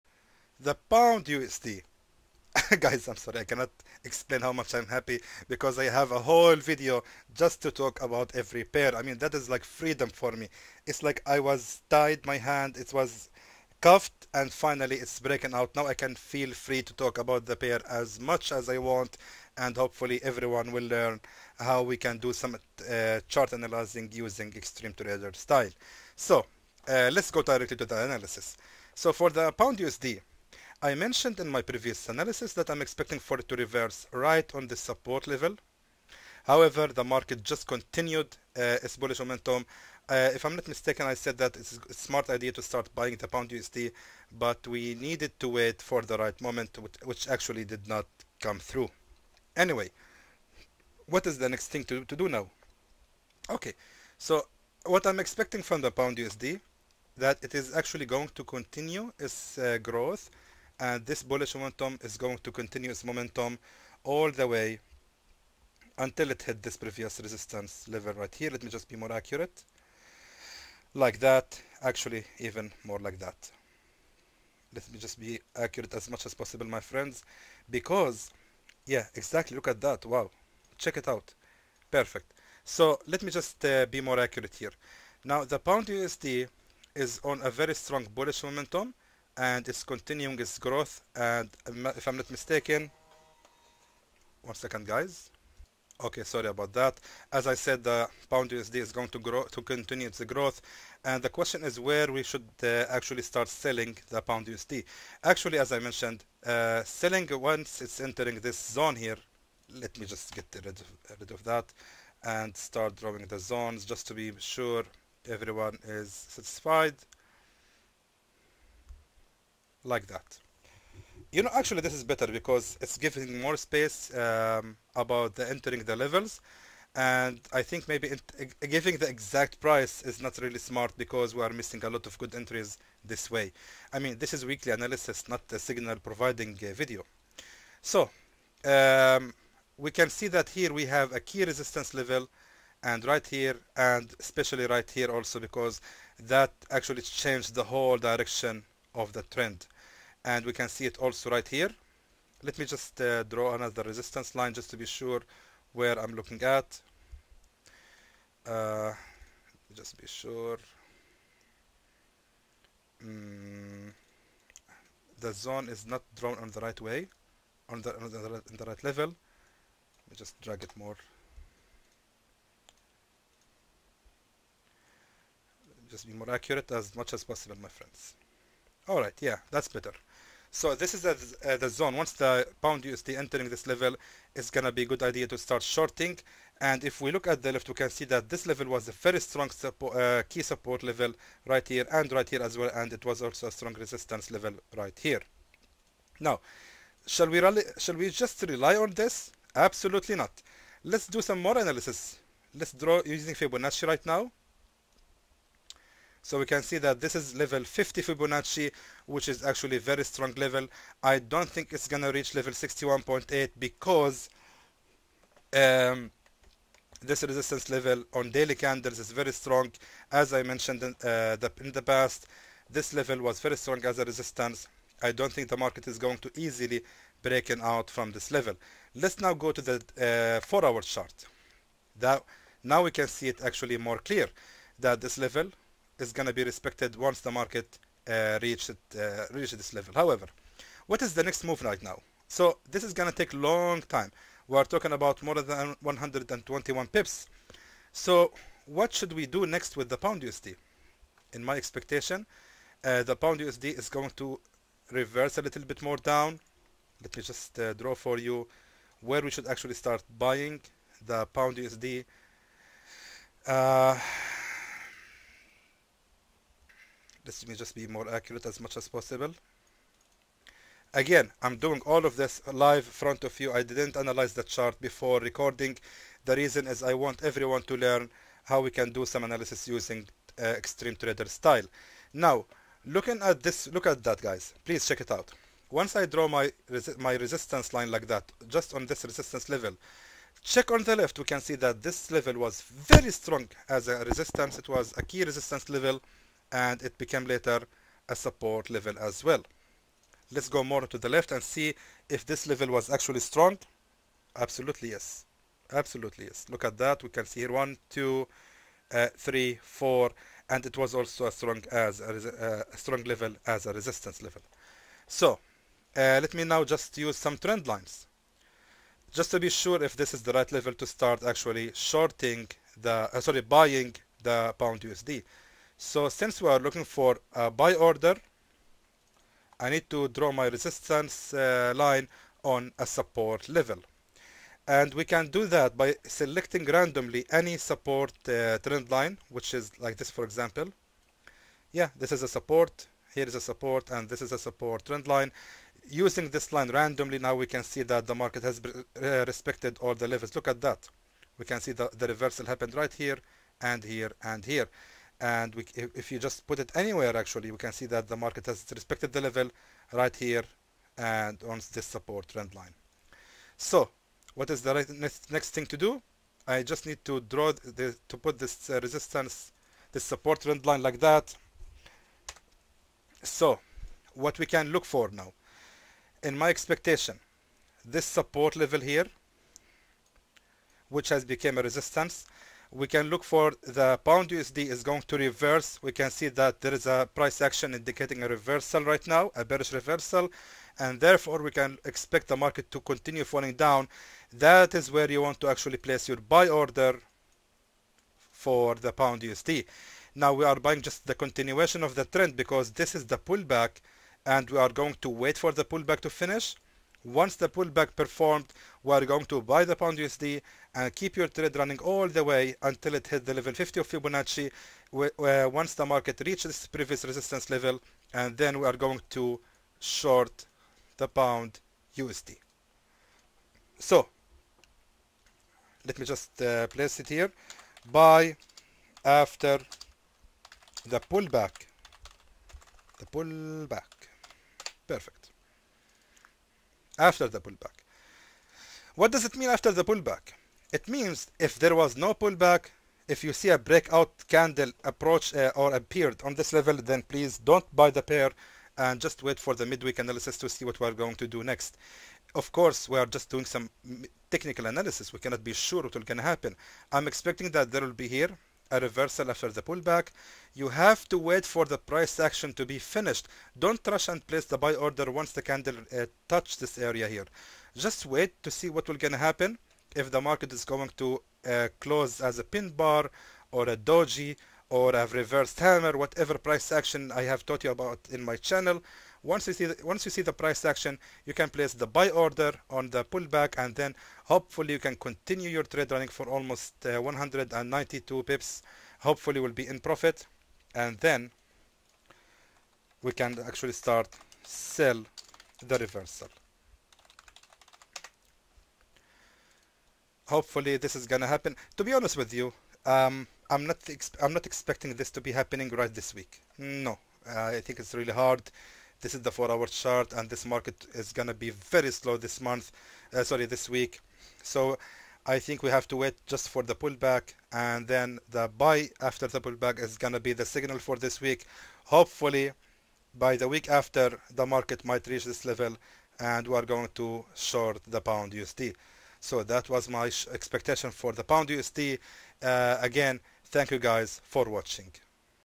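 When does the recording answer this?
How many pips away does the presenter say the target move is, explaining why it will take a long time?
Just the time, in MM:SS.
04:05.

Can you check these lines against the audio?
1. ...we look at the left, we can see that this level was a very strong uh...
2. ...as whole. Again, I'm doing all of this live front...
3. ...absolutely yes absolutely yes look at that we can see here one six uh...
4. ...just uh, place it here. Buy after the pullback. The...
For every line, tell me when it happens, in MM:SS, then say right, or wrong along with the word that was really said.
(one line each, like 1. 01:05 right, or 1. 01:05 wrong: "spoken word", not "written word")
1. 03:06 right
2. 04:28 wrong: "possible", not "whole"
3. 05:04 wrong: "two", not "six"
4. 07:06 right.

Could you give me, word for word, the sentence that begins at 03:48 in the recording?
Let's now go to the uh, four hour chart.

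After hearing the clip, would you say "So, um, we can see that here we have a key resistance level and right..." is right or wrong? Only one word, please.
right.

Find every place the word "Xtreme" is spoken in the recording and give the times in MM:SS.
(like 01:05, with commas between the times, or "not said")
00:24, 04:40.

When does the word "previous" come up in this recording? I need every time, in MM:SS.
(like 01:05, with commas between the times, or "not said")
00:31, 01:06, 06:56.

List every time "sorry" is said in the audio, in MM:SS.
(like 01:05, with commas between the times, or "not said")
00:03, 01:36, 05:23, 08:33.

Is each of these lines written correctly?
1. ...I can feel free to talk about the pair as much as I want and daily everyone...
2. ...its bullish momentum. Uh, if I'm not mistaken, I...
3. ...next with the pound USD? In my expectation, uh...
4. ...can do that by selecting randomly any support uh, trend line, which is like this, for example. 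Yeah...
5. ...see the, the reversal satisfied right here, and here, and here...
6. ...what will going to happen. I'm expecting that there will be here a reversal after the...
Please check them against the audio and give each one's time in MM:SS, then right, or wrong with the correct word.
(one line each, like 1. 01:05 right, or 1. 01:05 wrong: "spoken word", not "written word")
1. 00:15 wrong: "hopefully", not "daily"
2. 00:38 right
3. 04:09 right
4. 05:35 right
5. 05:51 wrong: "happened", not "satisfied"
6. 07:35 right.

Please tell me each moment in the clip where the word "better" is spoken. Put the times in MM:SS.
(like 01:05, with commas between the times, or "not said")
02:02, 02:59.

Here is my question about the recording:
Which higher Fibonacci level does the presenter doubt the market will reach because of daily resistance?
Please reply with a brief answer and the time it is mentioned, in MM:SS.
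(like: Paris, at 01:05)
61.8, at 03:32.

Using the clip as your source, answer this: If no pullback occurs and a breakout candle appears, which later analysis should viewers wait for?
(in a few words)
midweek analysis.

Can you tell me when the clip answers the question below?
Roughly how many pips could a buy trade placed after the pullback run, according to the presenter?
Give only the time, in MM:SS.
08:06.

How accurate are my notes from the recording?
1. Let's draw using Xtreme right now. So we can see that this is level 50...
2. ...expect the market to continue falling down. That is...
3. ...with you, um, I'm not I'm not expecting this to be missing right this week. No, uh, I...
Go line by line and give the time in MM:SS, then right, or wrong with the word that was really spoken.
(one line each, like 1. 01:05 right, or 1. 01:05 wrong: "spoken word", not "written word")
1. 03:22 wrong: "Fibonacci", not "Xtreme"
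2. 06:31 right
3. 08:22 wrong: "happening", not "missing".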